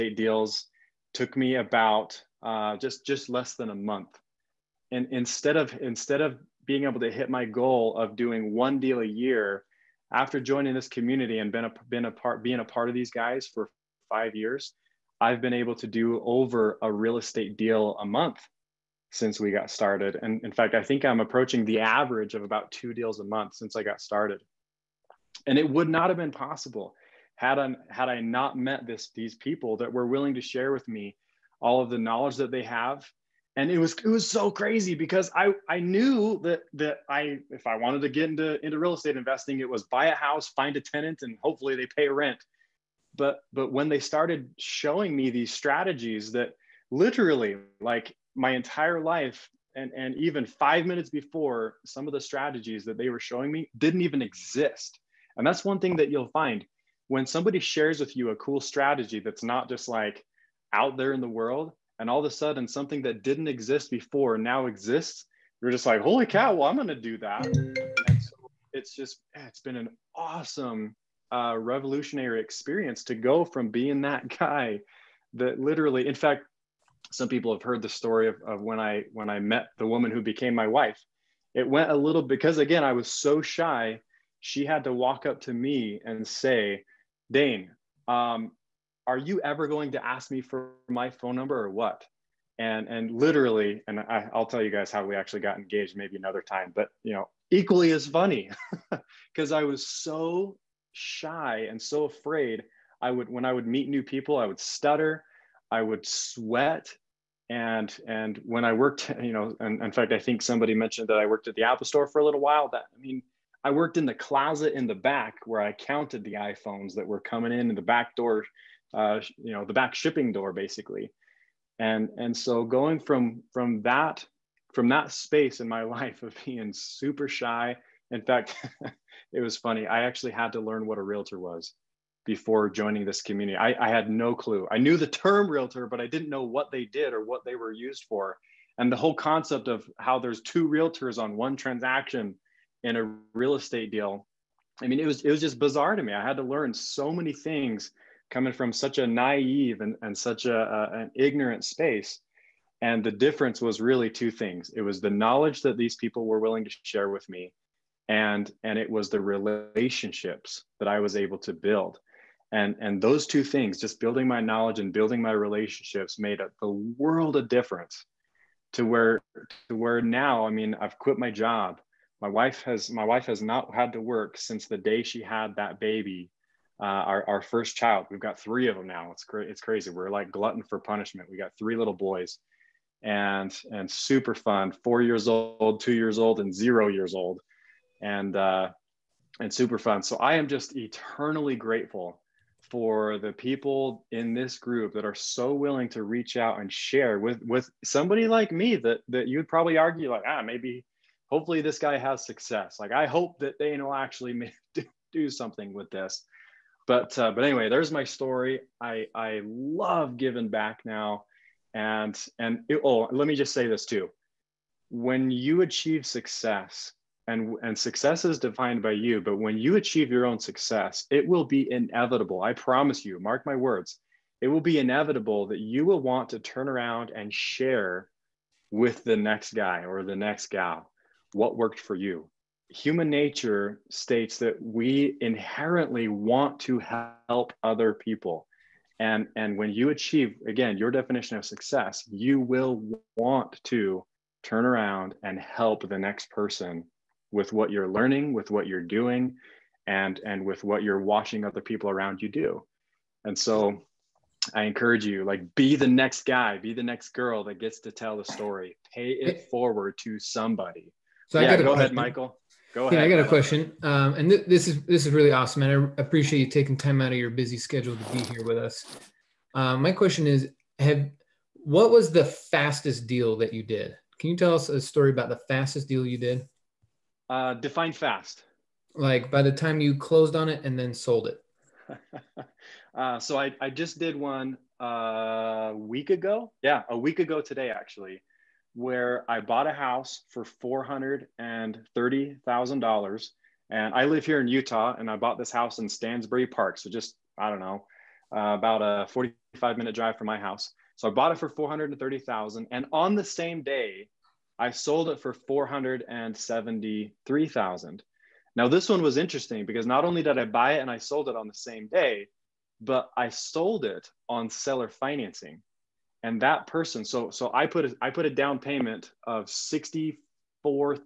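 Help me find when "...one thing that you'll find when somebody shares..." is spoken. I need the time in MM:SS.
00:55.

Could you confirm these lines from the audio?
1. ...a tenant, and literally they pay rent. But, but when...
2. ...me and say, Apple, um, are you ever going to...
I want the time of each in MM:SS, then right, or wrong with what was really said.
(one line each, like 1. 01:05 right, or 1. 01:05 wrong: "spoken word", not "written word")
1. 00:40 wrong: "hopefully", not "literally"
2. 01:25 wrong: "Daine", not "Apple".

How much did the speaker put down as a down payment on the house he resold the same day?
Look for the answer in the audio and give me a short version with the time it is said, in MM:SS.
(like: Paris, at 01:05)
$64,500, at 05:19.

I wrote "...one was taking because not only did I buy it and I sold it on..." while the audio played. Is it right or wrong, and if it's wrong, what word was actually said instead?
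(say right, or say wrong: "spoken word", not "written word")
wrong: "interesting", not "taking".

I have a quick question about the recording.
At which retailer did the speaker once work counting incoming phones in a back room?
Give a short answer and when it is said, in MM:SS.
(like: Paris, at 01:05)
Apple store, at 01:51.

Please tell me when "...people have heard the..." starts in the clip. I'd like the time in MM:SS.
01:17.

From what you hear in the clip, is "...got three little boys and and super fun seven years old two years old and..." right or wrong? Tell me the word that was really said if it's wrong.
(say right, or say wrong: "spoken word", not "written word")
wrong: "four", not "seven".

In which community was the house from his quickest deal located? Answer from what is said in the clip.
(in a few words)
Stansbury Park.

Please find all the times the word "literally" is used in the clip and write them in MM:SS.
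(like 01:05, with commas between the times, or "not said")
00:46, 01:15, 01:33.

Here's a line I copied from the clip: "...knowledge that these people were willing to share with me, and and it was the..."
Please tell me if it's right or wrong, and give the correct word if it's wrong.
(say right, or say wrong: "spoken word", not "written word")
right.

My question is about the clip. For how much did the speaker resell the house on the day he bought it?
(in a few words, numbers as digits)
$473,000.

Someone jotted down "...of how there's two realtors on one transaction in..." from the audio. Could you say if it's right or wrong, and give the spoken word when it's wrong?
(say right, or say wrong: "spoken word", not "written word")
right.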